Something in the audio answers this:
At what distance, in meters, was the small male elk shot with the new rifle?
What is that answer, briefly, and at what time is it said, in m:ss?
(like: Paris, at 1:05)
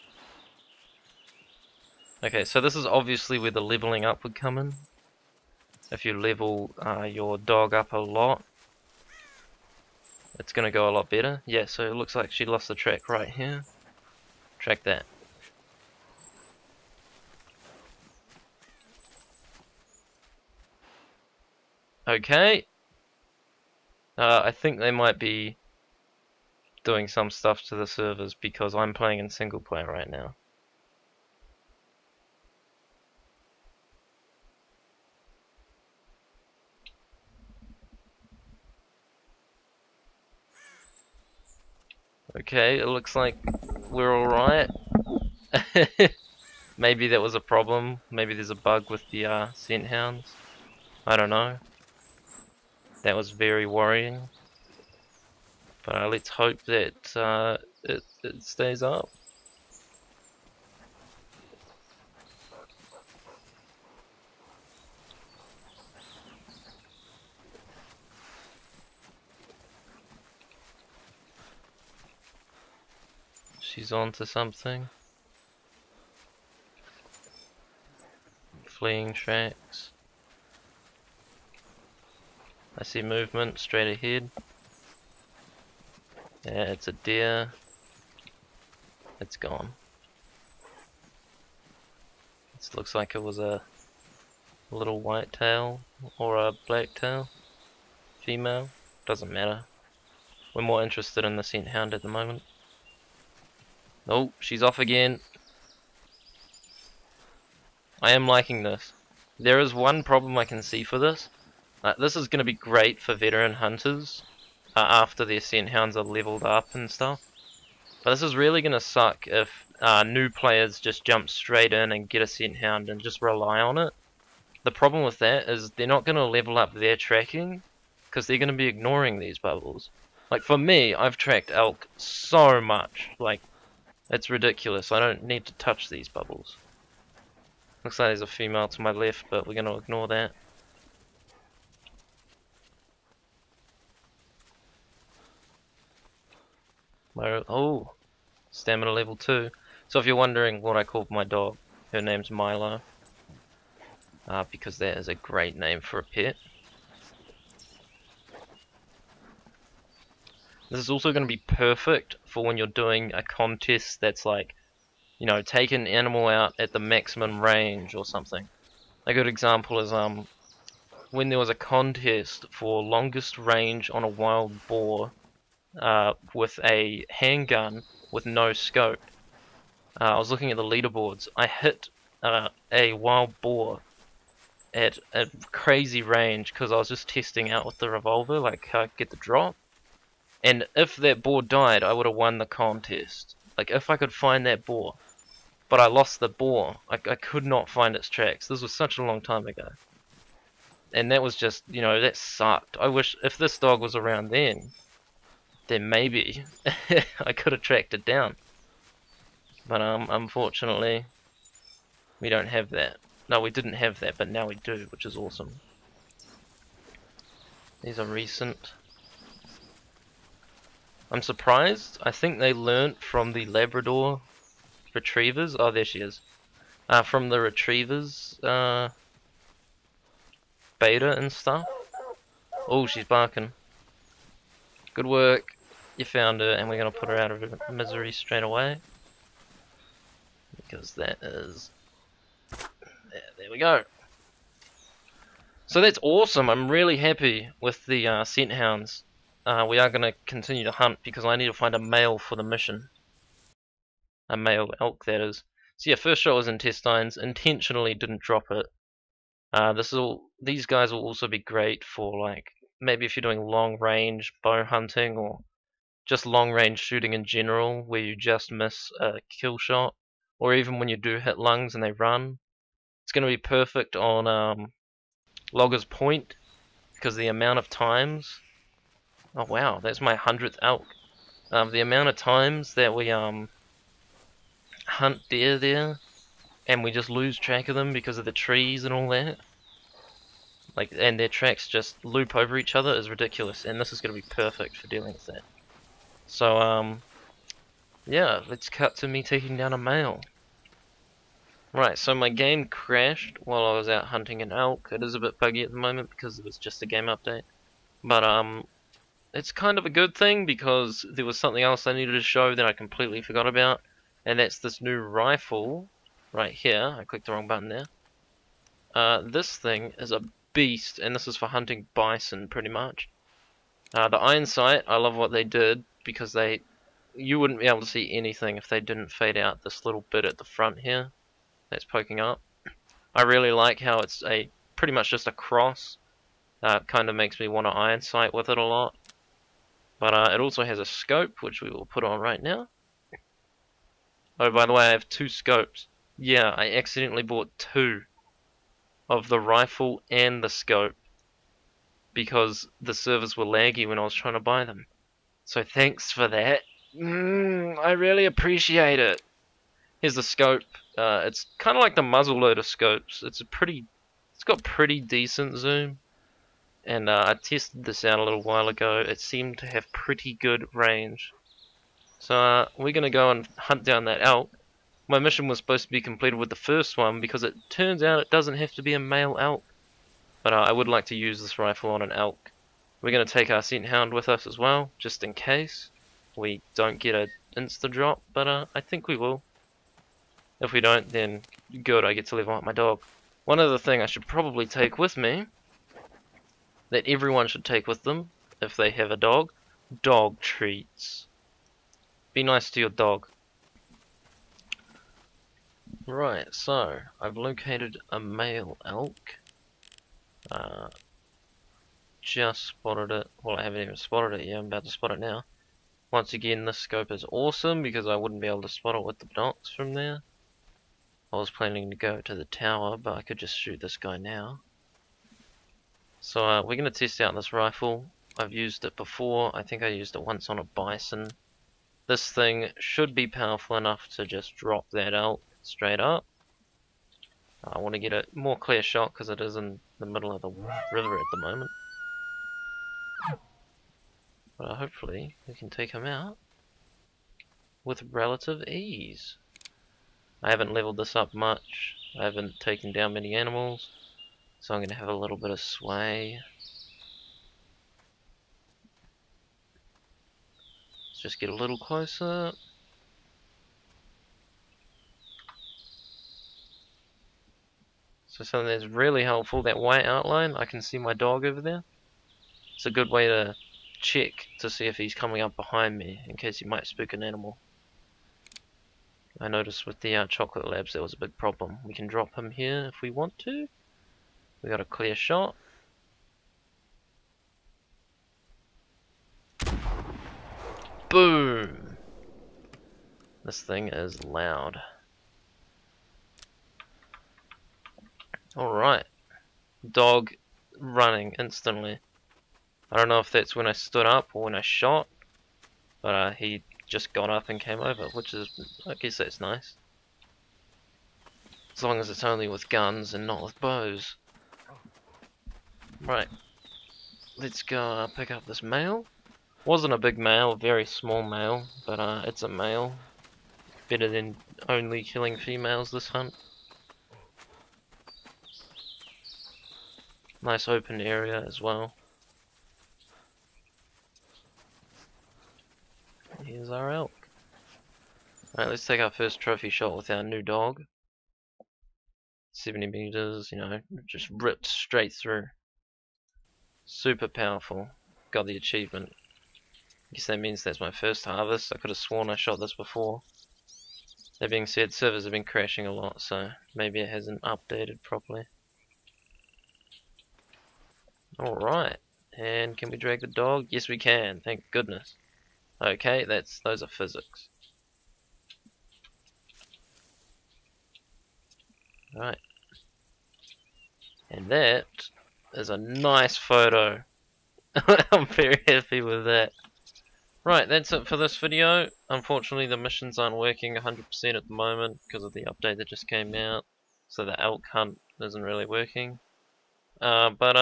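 70 meters, at 9:02.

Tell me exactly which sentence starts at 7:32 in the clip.
I haven't taken down many animals.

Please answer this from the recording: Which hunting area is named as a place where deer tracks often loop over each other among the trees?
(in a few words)
Logger's Point.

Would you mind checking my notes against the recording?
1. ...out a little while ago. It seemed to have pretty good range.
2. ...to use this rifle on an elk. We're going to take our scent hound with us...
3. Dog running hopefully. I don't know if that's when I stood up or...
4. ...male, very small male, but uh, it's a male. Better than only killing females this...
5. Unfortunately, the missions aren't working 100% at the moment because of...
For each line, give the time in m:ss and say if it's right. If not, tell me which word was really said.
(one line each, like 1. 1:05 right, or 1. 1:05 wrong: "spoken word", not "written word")
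1. 6:08 right
2. 6:21 right
3. 8:19 wrong: "instantly", not "hopefully"
4. 8:40 right
5. 9:42 right.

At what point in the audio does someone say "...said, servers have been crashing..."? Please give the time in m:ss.
9:14.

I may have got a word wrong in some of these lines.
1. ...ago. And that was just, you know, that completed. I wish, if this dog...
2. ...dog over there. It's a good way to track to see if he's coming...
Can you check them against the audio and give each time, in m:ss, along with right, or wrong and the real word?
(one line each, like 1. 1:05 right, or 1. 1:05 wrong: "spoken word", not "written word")
1. 3:19 wrong: "sucked", not "completed"
2. 7:51 wrong: "check", not "track".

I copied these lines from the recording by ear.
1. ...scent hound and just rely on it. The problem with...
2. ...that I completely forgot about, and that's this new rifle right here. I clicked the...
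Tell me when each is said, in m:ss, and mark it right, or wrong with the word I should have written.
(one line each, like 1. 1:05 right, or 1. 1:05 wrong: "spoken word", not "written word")
1. 2:02 right
2. 5:12 right.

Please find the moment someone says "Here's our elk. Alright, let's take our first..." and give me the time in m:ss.
8:56.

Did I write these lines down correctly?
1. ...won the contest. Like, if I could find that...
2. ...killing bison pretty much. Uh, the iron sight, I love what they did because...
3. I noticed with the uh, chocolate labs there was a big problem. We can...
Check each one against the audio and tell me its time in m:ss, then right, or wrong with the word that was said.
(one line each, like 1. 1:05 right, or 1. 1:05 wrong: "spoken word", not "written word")
1. 3:12 right
2. 5:21 wrong: "hunting", not "killing"
3. 7:59 right.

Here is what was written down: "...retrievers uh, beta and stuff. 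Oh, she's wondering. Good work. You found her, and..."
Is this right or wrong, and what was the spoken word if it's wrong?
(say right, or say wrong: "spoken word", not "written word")
wrong: "barking", not "wondering".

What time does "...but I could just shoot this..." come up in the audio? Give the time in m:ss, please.
7:02.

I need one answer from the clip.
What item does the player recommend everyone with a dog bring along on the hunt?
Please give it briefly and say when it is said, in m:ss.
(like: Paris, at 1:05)
Dog treats, at 6:40.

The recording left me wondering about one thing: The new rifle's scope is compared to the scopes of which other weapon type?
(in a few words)
Muzzleloader.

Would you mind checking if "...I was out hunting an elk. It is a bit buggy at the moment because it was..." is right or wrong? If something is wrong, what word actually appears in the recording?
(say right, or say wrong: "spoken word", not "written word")
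right.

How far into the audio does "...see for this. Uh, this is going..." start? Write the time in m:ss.
1:50.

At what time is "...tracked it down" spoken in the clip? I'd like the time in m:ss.
3:27.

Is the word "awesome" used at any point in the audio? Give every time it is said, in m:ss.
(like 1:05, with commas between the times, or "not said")
3:35, 4:06, 6:57.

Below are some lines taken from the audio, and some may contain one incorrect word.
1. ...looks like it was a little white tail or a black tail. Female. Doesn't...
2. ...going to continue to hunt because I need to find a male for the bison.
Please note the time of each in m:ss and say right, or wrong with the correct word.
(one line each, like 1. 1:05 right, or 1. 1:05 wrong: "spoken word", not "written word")
1. 1:32 right
2. 4:09 wrong: "mission", not "bison".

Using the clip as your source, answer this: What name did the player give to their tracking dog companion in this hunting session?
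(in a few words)
Milo.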